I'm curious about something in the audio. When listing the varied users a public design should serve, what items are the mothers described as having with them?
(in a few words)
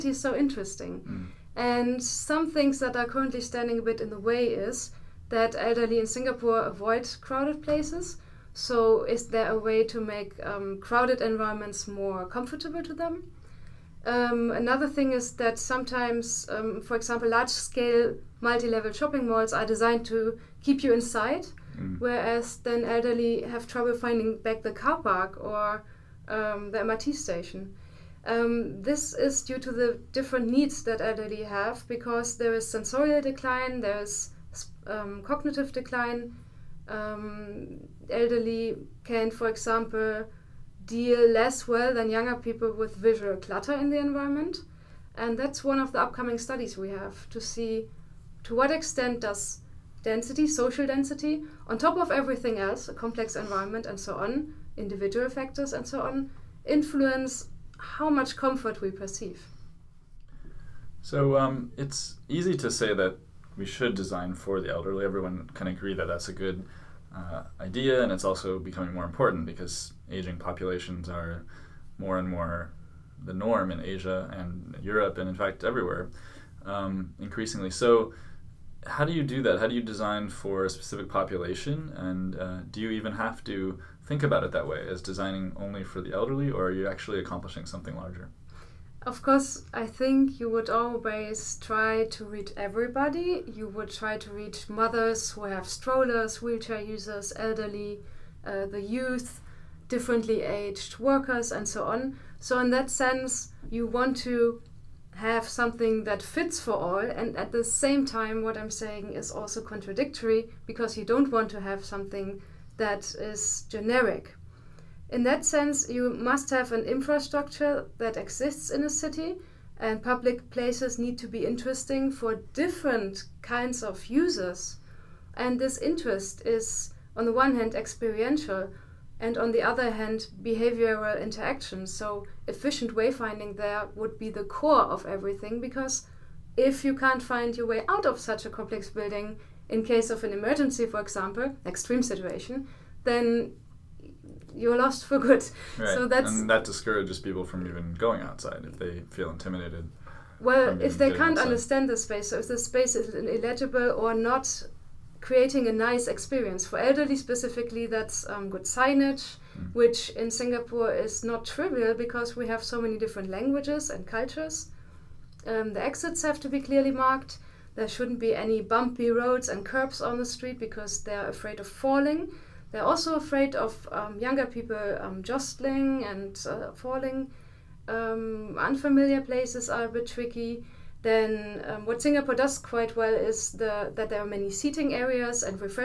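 strollers.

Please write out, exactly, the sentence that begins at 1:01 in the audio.
So um, it's easy to say that we should design for the elderly.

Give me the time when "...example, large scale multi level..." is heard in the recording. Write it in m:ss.
0:16.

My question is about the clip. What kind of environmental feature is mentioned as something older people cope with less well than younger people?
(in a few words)
visual clutter.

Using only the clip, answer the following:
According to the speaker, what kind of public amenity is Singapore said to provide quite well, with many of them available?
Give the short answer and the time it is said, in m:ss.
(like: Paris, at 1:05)
seating areas, at 3:04.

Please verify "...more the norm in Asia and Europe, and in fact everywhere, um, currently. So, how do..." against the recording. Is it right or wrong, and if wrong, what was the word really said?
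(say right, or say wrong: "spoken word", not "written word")
wrong: "increasingly", not "currently".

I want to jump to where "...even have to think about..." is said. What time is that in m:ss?
1:22.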